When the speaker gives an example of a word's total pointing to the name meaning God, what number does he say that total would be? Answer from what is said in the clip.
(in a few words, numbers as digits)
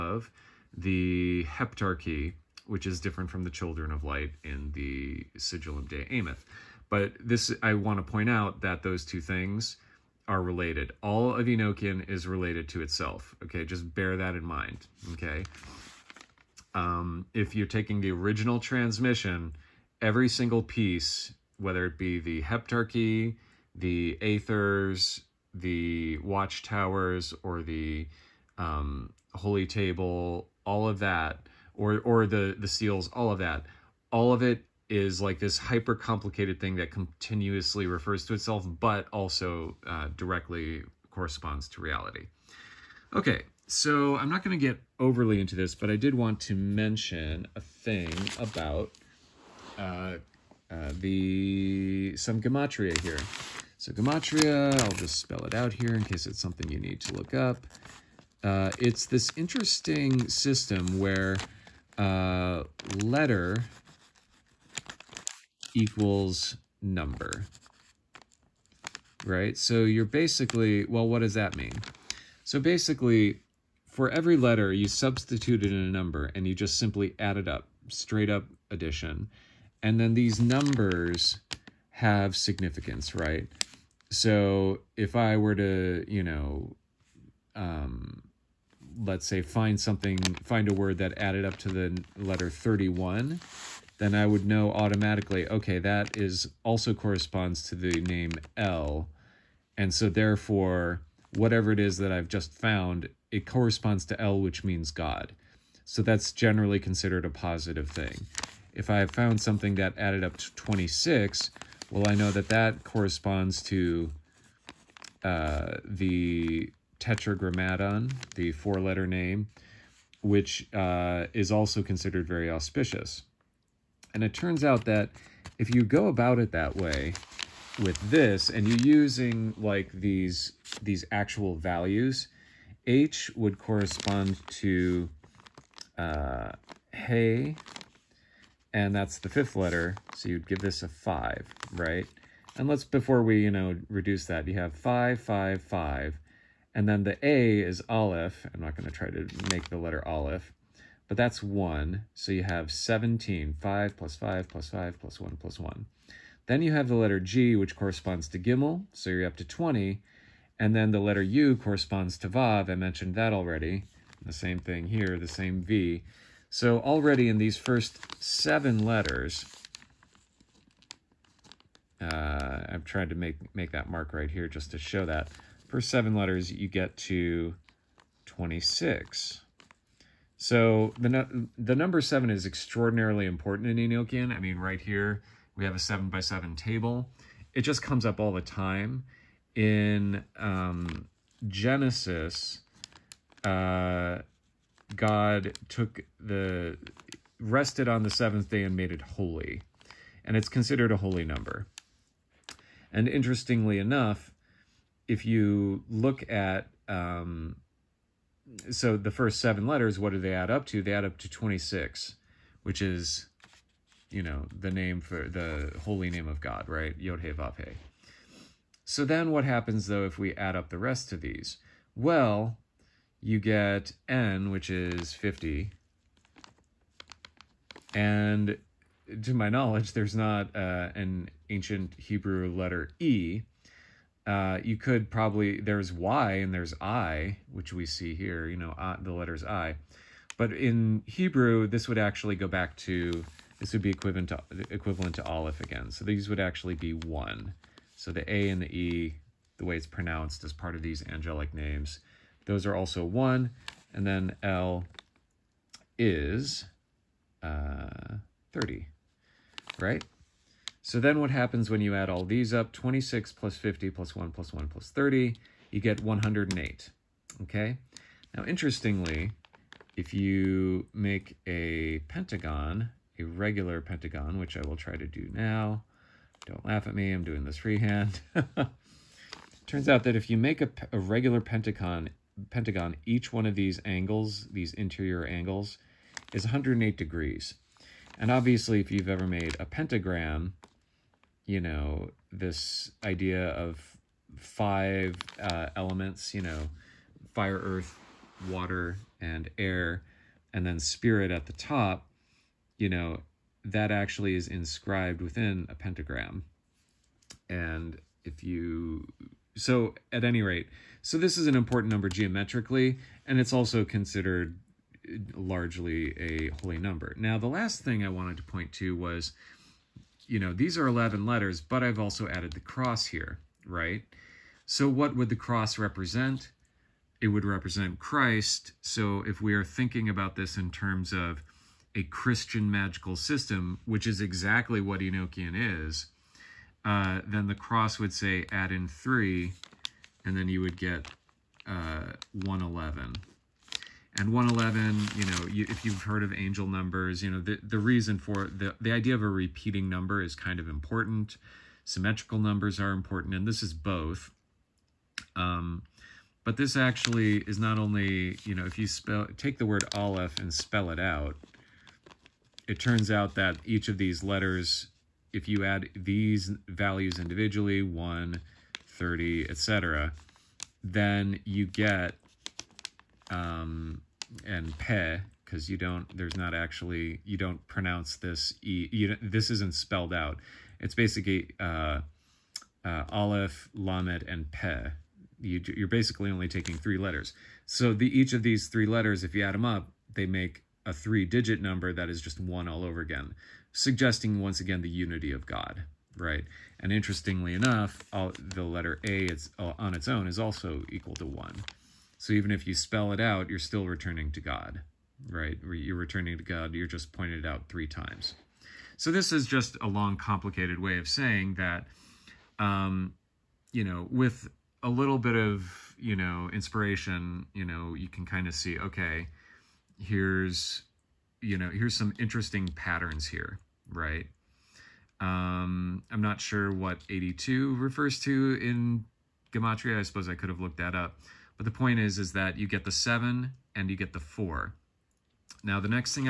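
31.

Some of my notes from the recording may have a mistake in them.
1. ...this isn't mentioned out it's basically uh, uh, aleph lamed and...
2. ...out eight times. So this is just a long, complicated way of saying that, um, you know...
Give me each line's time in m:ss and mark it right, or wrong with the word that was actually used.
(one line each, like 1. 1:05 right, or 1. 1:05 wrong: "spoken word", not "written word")
1. 6:19 wrong: "spelled", not "mentioned"
2. 6:47 wrong: "three", not "eight".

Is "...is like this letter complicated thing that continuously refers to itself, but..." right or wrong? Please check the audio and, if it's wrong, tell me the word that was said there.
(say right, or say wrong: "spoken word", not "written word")
wrong: "hyper", not "letter".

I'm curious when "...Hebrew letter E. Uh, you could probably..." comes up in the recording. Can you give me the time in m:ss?
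3:51.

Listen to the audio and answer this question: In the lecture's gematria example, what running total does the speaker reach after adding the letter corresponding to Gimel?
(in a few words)
20.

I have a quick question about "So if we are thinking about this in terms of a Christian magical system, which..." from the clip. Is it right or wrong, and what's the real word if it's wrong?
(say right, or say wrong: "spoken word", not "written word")
right.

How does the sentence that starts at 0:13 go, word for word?
Okay, just bear that in mind.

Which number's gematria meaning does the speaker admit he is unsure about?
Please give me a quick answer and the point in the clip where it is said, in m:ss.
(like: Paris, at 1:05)
82, at 7:07.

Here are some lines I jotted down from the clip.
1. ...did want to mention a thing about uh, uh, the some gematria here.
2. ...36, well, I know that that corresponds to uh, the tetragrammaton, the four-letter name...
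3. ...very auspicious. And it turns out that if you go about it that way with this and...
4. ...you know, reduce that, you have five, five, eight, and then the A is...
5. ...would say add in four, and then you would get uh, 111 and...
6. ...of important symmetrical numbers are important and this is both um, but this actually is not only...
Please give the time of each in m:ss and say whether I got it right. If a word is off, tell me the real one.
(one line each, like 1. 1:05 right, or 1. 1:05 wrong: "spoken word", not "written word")
1. 0:45 right
2. 1:50 wrong: "26", not "36"
3. 2:02 right
4. 2:23 wrong: "five", not "eight"
5. 5:37 wrong: "three", not "four"
6. 5:50 right.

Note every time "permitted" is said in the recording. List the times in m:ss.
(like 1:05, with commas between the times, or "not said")
not said.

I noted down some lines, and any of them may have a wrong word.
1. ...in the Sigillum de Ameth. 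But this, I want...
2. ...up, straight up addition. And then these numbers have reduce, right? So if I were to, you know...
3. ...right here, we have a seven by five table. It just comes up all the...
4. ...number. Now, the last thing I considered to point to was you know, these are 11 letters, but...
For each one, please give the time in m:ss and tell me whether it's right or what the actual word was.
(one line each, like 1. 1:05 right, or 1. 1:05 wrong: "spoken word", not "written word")
1. 0:04 right
2. 1:17 wrong: "significance", not "reduce"
3. 3:04 wrong: "seven", not "five"
4. 5:16 wrong: "wanted", not "considered".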